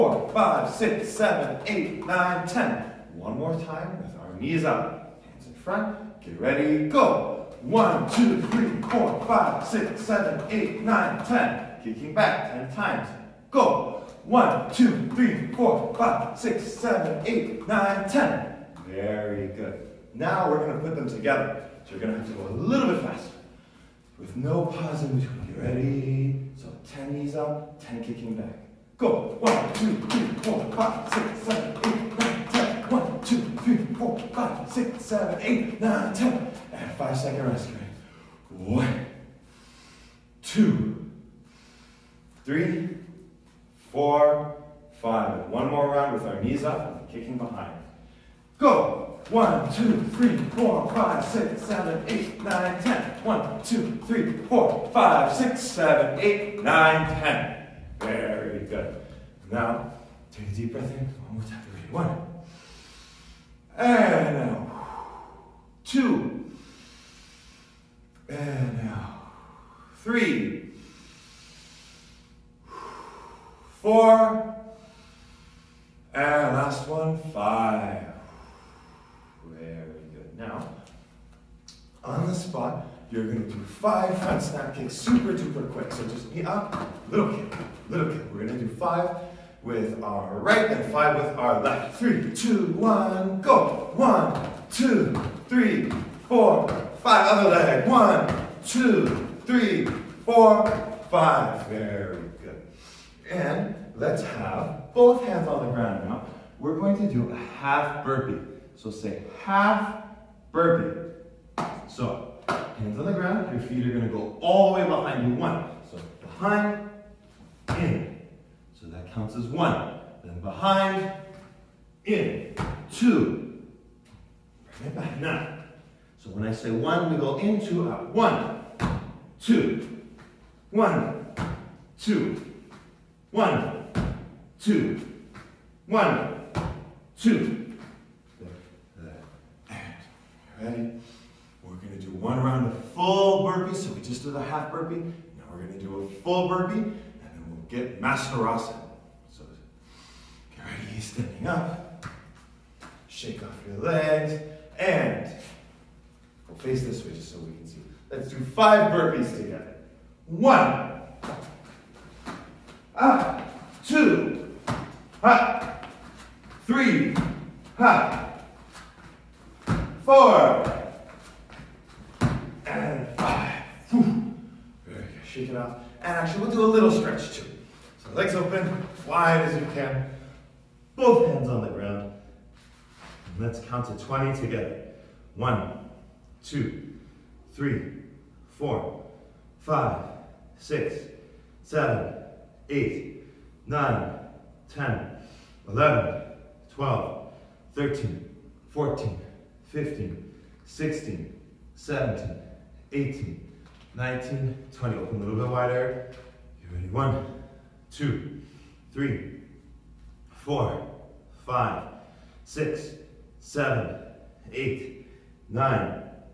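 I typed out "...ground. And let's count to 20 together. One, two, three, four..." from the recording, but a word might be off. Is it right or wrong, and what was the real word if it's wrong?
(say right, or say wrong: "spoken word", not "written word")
right.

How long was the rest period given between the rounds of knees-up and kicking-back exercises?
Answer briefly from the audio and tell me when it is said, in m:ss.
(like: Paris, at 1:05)
5 seconds, at 0:36.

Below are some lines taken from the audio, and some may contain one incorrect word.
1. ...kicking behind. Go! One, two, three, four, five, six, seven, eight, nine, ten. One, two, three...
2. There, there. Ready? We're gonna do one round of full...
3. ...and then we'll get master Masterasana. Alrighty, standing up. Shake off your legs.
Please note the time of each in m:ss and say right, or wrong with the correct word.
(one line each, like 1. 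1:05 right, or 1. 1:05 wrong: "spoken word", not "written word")
1. 0:47 right
2. 2:18 right
3. 2:26 right.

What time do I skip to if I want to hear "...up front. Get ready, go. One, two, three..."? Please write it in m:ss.
0:04.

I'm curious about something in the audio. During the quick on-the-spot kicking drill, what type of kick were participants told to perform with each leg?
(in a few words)
front snap kicks.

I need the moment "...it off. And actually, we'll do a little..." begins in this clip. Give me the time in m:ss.
2:55.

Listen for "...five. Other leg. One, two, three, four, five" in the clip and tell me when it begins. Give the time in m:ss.
1:37.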